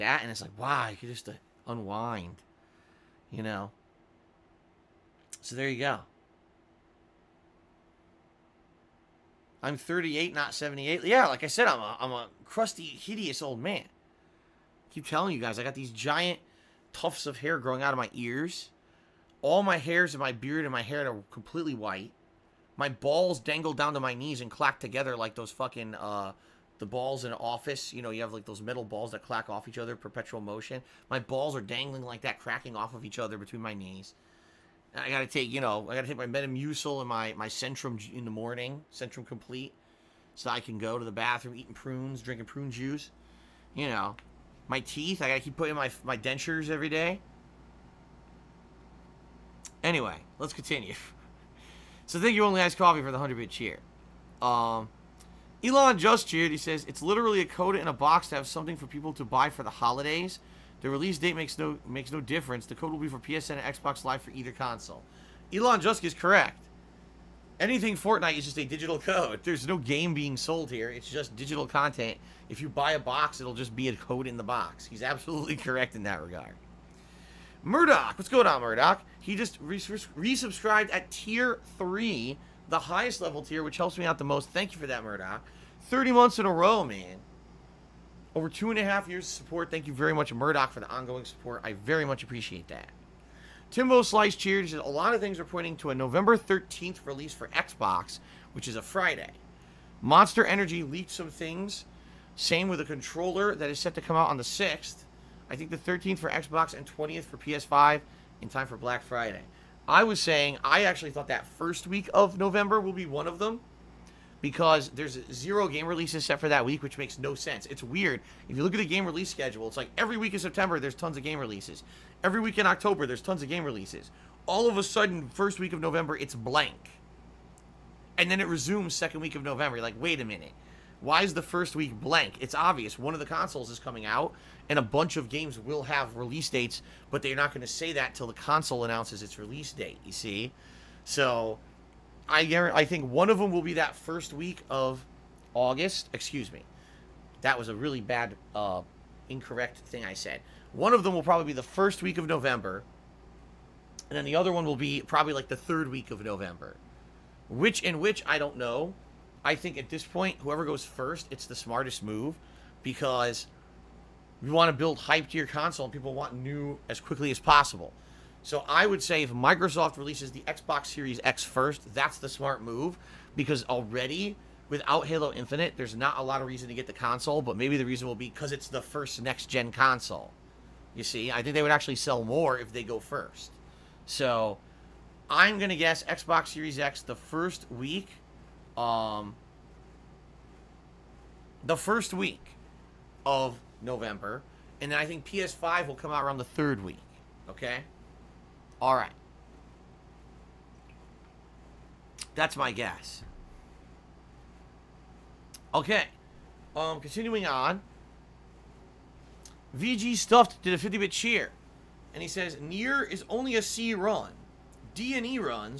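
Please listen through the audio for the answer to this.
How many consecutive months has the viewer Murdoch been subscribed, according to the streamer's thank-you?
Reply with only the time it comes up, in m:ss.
1:25.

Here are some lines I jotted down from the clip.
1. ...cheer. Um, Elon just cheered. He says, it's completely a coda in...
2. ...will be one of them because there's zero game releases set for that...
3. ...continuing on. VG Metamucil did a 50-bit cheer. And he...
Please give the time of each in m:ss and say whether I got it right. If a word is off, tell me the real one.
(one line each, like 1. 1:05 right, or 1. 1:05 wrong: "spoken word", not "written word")
1. 0:53 wrong: "literally", not "completely"
2. 1:52 right
3. 3:27 wrong: "Stuffed", not "Metamucil".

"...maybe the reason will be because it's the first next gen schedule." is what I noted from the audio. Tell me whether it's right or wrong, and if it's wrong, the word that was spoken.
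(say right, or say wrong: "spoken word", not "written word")
wrong: "console", not "schedule".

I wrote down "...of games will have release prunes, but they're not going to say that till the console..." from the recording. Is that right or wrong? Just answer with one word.
wrong.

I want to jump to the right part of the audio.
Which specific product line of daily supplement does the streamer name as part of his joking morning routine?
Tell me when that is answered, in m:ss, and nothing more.
0:38.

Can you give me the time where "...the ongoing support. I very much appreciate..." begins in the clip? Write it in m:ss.
1:30.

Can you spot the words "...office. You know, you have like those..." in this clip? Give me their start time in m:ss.
0:27.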